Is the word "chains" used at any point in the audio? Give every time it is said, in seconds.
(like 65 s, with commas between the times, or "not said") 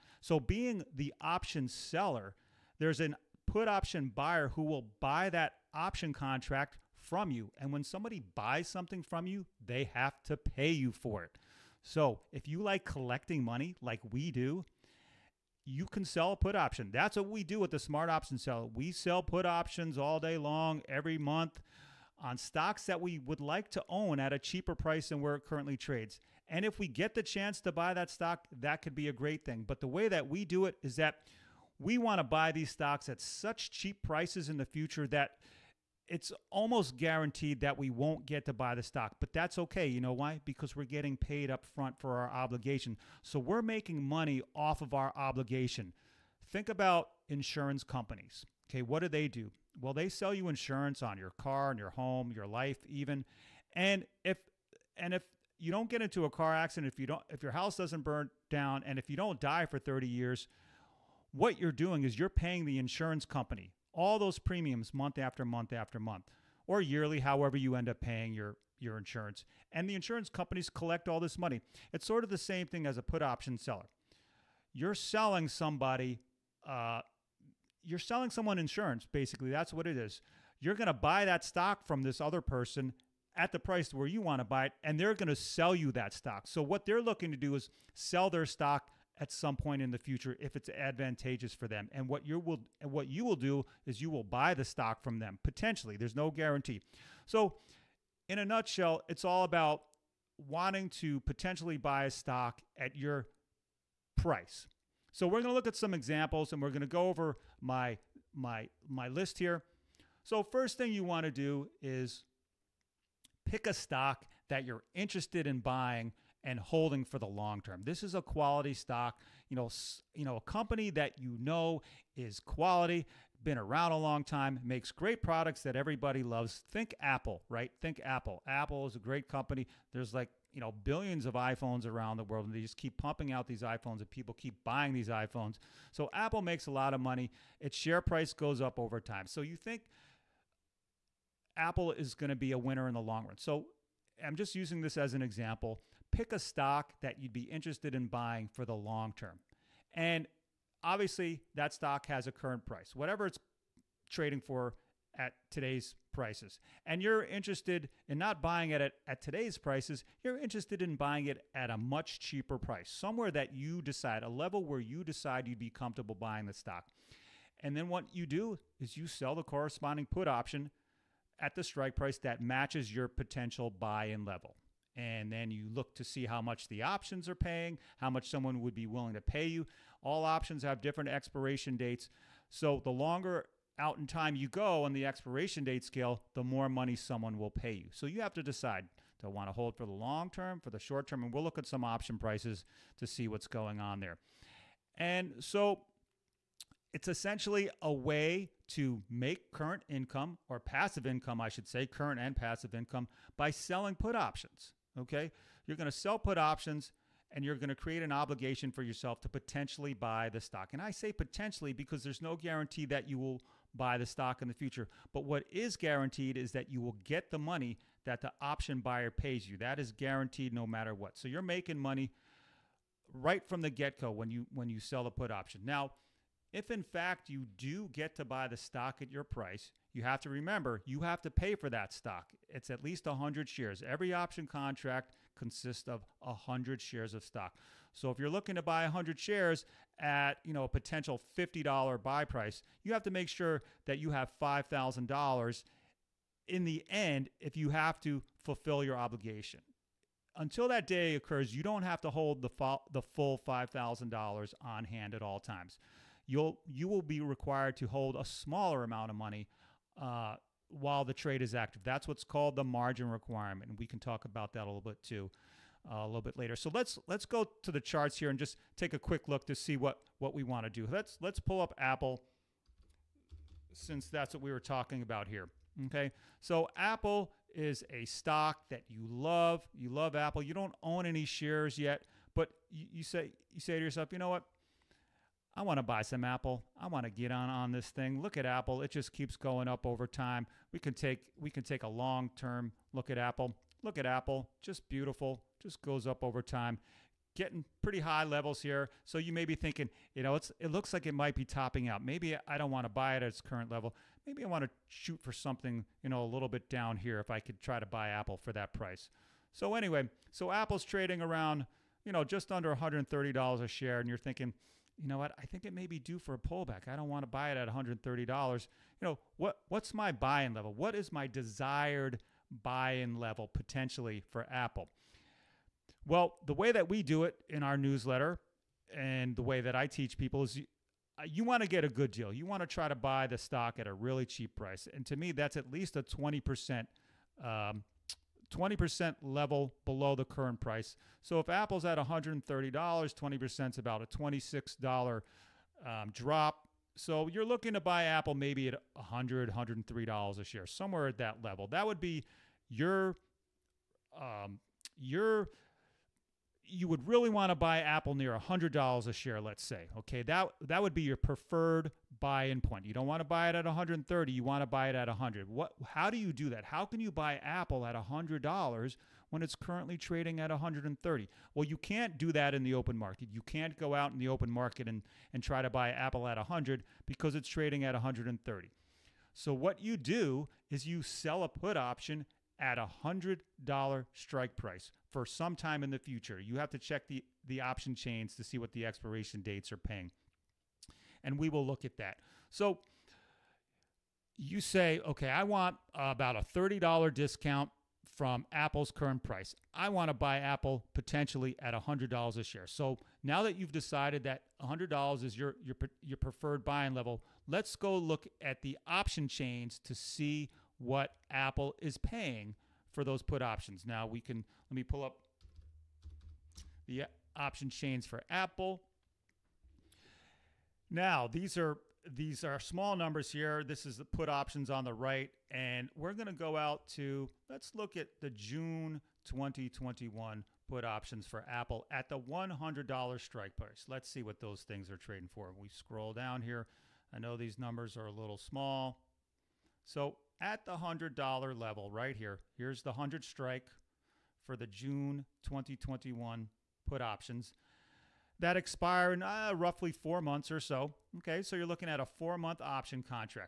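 387 s, 409 s, 417 s.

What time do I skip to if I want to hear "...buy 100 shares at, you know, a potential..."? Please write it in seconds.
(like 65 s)
238 s.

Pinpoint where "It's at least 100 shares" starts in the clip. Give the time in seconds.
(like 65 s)
232 s.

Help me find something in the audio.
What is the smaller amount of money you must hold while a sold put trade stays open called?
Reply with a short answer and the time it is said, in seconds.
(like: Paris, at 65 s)
Margin requirement, at 262 s.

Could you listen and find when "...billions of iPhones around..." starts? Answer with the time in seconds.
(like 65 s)
130 s.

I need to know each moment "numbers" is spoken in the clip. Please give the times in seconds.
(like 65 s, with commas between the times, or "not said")
422 s, 437 s.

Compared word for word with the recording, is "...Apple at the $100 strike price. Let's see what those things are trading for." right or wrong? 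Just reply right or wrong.
right.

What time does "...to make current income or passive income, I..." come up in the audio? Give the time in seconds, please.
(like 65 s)
198 s.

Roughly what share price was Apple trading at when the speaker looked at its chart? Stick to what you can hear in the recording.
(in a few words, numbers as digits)
Just under $130.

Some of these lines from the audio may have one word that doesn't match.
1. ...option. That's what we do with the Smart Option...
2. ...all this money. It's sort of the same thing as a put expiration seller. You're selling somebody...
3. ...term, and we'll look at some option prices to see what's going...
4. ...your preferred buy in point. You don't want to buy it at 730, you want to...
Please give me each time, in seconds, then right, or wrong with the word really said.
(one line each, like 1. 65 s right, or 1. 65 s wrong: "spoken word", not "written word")
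1. 16 s right
2. 71 s wrong: "option", not "expiration"
3. 191 s right
4. 361 s wrong: "130", not "730".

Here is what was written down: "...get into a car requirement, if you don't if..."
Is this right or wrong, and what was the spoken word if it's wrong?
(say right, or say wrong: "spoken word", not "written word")
wrong: "accident", not "requirement".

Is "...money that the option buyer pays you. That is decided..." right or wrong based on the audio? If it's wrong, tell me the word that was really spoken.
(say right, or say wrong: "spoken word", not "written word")
wrong: "guaranteed", not "decided".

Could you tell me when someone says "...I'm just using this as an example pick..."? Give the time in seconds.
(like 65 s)
144 s.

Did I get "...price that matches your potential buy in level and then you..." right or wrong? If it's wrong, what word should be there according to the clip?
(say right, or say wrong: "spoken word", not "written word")
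right.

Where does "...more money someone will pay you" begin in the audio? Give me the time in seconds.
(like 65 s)
186 s.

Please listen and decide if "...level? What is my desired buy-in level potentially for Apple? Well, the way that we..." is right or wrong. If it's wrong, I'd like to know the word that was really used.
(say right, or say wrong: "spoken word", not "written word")
right.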